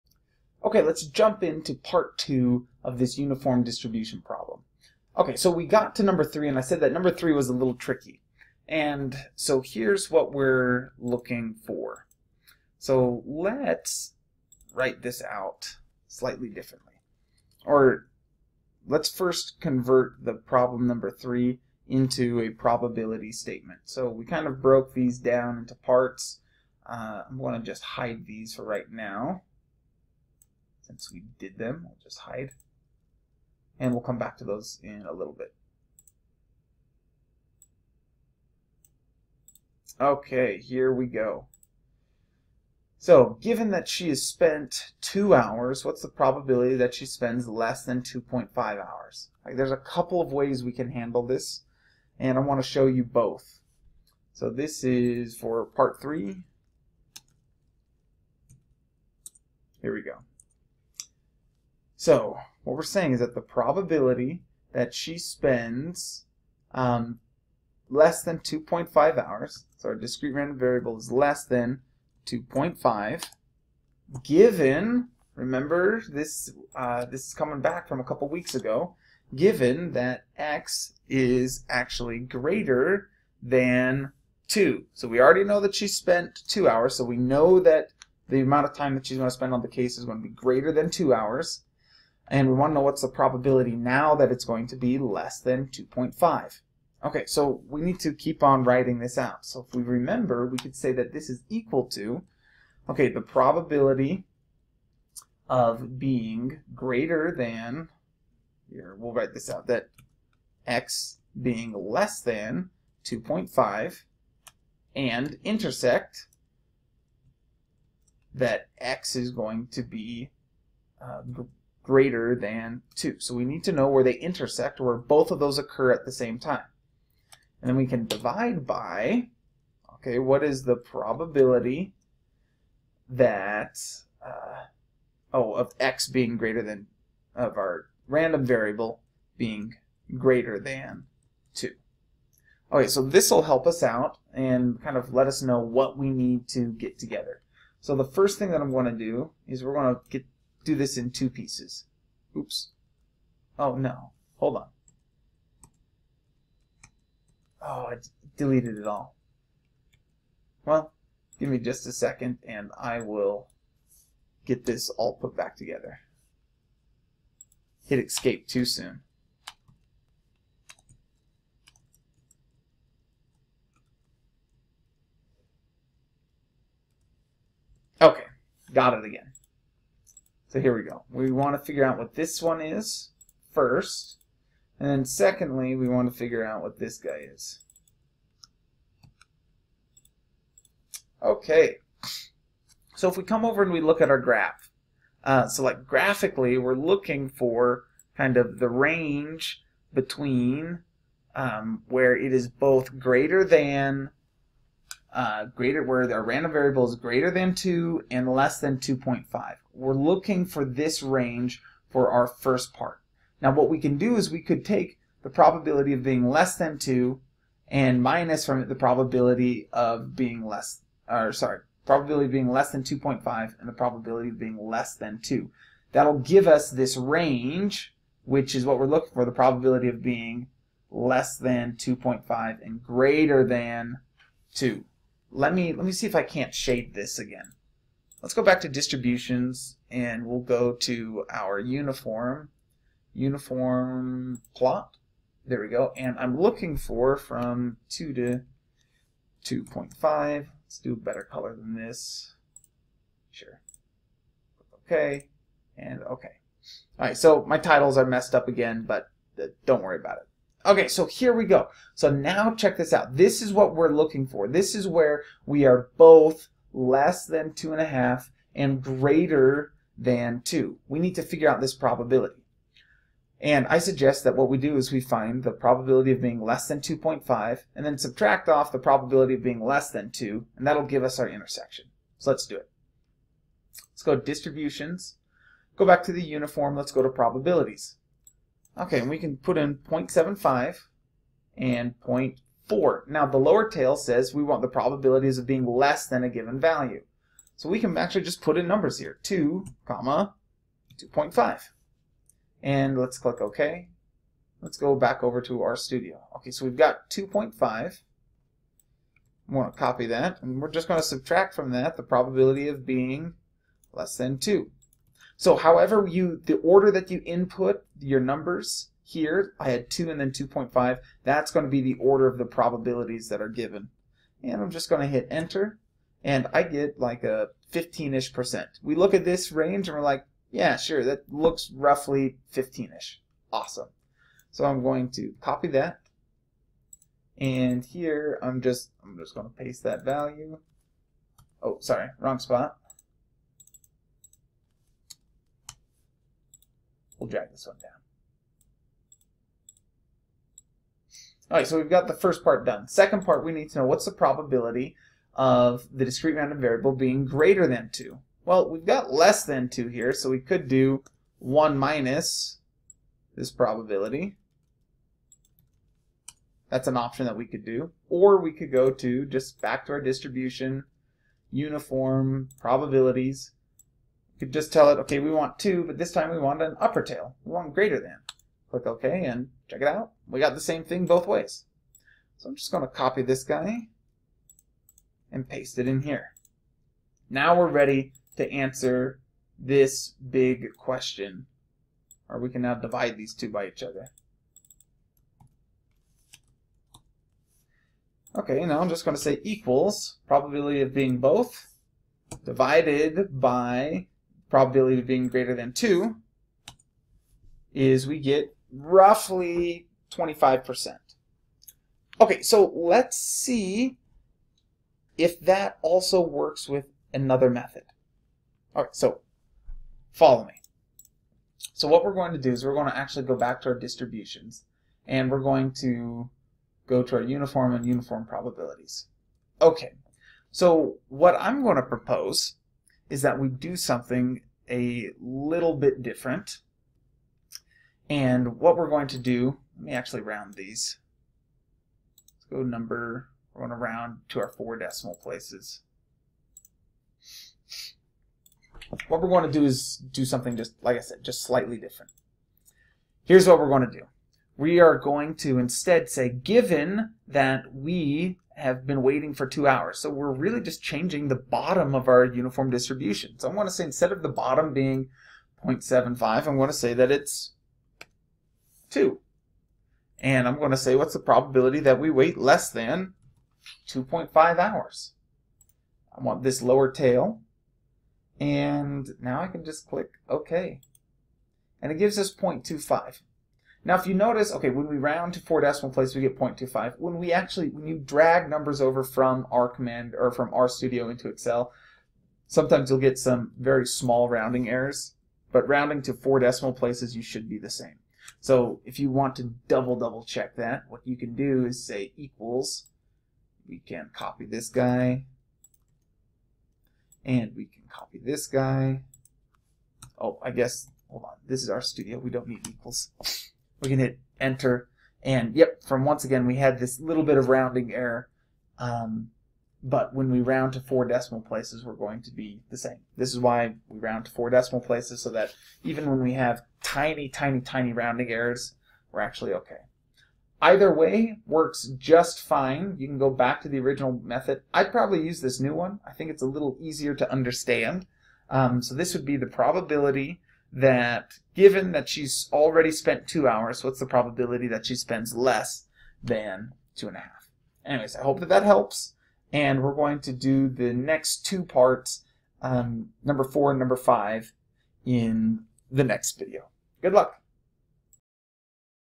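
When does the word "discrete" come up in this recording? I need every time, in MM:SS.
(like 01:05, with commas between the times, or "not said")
01:09, 05:56.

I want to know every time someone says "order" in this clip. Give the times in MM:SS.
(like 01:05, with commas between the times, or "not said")
05:16, 05:21.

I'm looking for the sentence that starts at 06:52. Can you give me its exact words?
Okay, so let's see if that also works with another method.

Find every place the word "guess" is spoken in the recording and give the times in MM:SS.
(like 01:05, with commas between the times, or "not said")
08:30.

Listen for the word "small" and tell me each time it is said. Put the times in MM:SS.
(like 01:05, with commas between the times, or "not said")
08:13.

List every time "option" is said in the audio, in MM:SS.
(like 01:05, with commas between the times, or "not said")
06:06.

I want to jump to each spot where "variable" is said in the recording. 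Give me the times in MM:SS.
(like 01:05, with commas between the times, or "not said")
01:10, 02:18, 03:26, 05:56.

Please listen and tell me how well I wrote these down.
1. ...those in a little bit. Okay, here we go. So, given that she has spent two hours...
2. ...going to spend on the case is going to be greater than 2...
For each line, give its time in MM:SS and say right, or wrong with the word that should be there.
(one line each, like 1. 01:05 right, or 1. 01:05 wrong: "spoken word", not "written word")
1. 00:34 right
2. 01:29 right.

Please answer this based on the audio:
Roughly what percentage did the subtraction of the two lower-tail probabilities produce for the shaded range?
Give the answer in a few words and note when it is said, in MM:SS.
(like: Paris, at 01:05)
15%, at 05:27.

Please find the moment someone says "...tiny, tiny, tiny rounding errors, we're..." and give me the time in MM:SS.
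08:46.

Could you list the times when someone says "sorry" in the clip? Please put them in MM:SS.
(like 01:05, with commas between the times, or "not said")
03:41, 05:41.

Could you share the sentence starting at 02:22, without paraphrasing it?
Okay, so this will help us out and kind of let us know what we need to get together.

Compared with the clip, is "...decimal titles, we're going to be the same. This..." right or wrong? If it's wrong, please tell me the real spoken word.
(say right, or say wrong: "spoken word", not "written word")
wrong: "places", not "titles".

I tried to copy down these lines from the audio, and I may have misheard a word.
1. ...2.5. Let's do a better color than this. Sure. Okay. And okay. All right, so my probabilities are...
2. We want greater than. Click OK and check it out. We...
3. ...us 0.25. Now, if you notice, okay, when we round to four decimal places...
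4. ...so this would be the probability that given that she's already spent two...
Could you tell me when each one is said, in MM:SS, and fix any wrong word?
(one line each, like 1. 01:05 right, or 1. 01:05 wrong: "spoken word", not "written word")
1. 04:09 wrong: "titles", not "probabilities"
2. 06:17 right
3. 08:02 right
4. 08:58 right.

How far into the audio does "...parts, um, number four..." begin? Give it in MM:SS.
09:11.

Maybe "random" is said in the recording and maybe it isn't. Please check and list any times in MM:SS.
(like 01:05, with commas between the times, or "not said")
01:10, 02:18, 03:26, 05:56.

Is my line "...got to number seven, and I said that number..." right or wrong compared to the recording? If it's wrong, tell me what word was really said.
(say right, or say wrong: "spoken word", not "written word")
wrong: "three", not "seven".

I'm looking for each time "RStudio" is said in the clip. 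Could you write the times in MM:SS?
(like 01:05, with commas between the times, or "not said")
05:05, 08:10, 08:31.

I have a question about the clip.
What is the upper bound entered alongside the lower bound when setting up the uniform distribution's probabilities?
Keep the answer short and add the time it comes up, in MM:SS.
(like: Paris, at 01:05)
0.4, at 04:52.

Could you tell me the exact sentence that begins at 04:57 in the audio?
So we can actually just put in numbers here, 2, comma, 2.5.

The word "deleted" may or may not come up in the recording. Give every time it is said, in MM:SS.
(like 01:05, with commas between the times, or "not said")
02:38.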